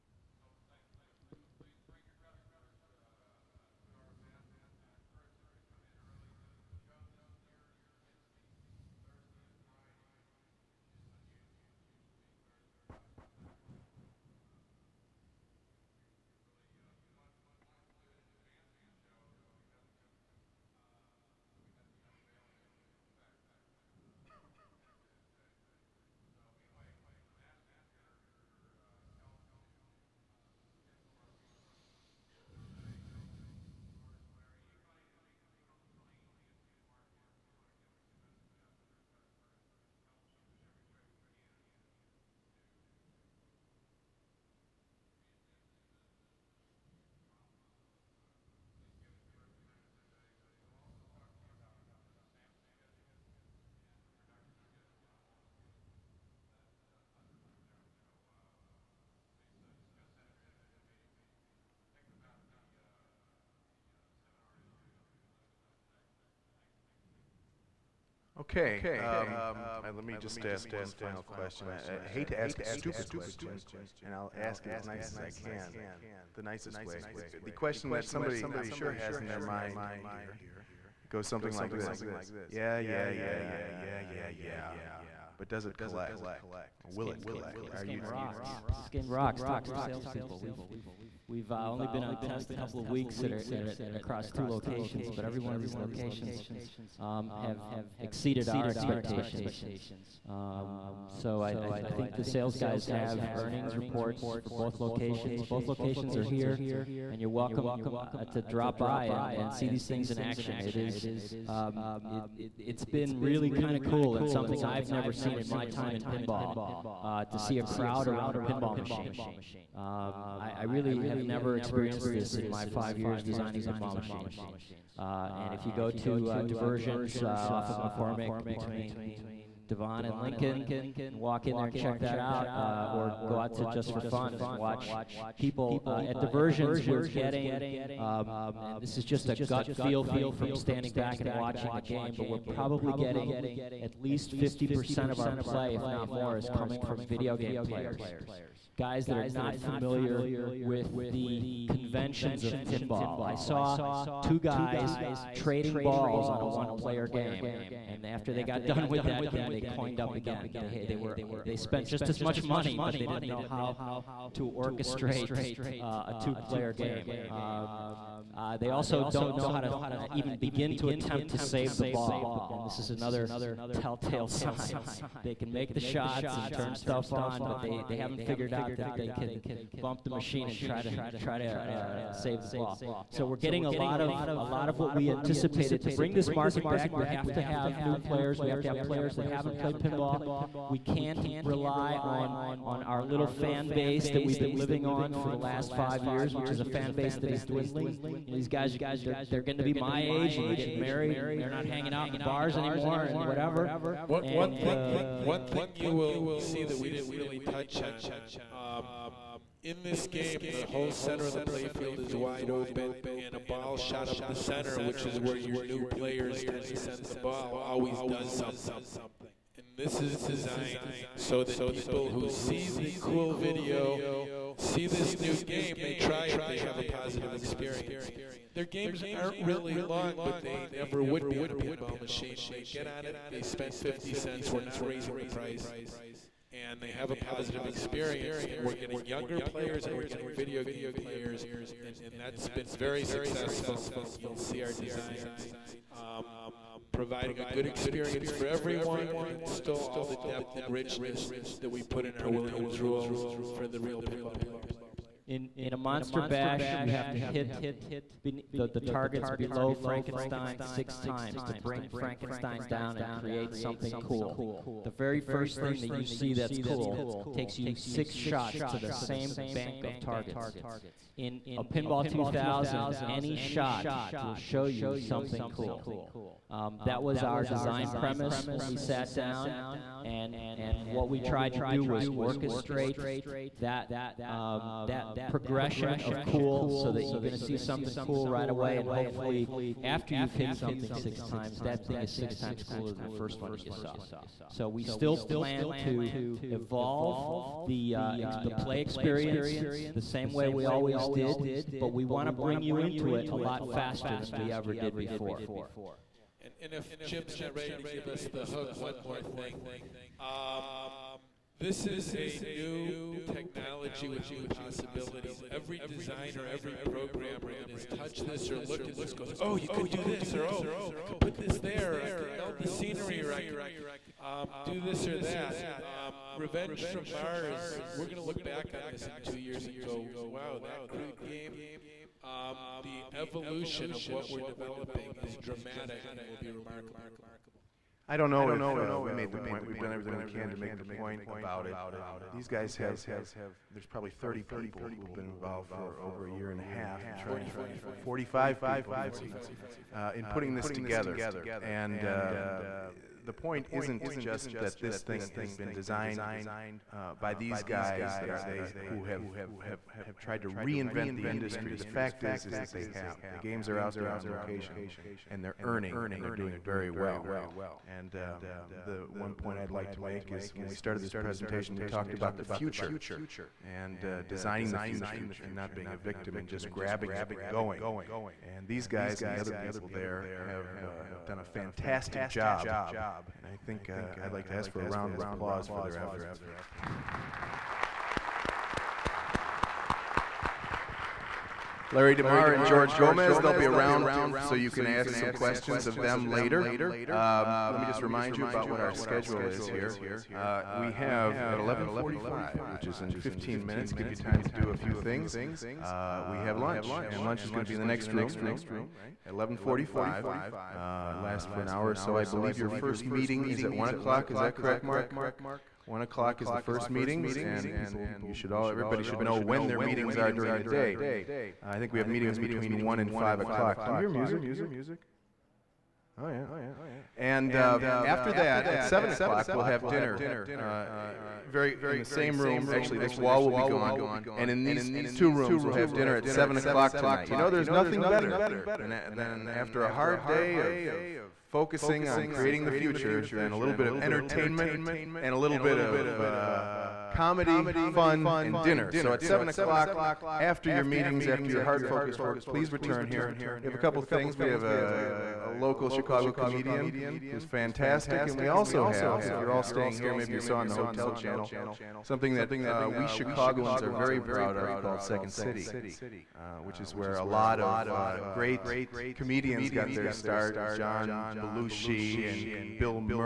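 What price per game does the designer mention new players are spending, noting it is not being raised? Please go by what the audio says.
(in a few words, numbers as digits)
50 cents.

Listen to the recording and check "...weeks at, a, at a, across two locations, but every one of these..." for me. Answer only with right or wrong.
right.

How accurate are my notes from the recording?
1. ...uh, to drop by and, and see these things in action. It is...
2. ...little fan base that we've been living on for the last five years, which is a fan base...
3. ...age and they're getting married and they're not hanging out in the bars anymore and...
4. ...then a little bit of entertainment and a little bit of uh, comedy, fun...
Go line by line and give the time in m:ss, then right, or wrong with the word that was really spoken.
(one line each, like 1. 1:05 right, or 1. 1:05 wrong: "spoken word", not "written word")
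1. 1:47 right
2. 3:13 right
3. 3:20 right
4. 7:23 right.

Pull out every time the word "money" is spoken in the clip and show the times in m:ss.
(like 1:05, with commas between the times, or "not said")
2:42.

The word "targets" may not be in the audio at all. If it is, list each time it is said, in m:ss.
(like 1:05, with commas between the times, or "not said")
4:18, 4:29.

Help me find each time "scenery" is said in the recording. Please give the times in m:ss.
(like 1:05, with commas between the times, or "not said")
5:22.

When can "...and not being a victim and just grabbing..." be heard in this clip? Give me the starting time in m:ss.
6:15.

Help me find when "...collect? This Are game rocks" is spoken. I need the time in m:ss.
1:27.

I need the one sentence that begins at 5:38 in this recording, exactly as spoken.
I don't know if uh, we made the point.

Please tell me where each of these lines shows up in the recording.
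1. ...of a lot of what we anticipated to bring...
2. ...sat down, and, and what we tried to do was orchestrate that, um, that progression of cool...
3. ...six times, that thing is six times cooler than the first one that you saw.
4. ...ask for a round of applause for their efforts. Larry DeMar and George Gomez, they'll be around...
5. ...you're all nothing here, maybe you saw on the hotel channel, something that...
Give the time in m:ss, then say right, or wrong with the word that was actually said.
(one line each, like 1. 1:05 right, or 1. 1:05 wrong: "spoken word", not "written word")
1. 3:04 right
2. 4:38 right
3. 4:50 right
4. 6:24 right
5. 7:39 wrong: "staying", not "nothing".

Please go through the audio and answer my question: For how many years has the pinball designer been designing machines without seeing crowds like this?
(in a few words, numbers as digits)
5.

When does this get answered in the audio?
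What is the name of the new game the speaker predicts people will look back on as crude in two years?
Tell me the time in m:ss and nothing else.
5:26.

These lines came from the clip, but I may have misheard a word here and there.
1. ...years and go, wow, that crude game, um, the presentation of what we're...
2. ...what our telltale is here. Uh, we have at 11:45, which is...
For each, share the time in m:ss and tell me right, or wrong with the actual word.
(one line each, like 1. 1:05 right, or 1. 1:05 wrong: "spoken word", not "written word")
1. 5:29 wrong: "evolution", not "presentation"
2. 6:38 wrong: "schedule", not "telltale".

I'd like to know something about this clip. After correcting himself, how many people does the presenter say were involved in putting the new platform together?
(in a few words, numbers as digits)
45.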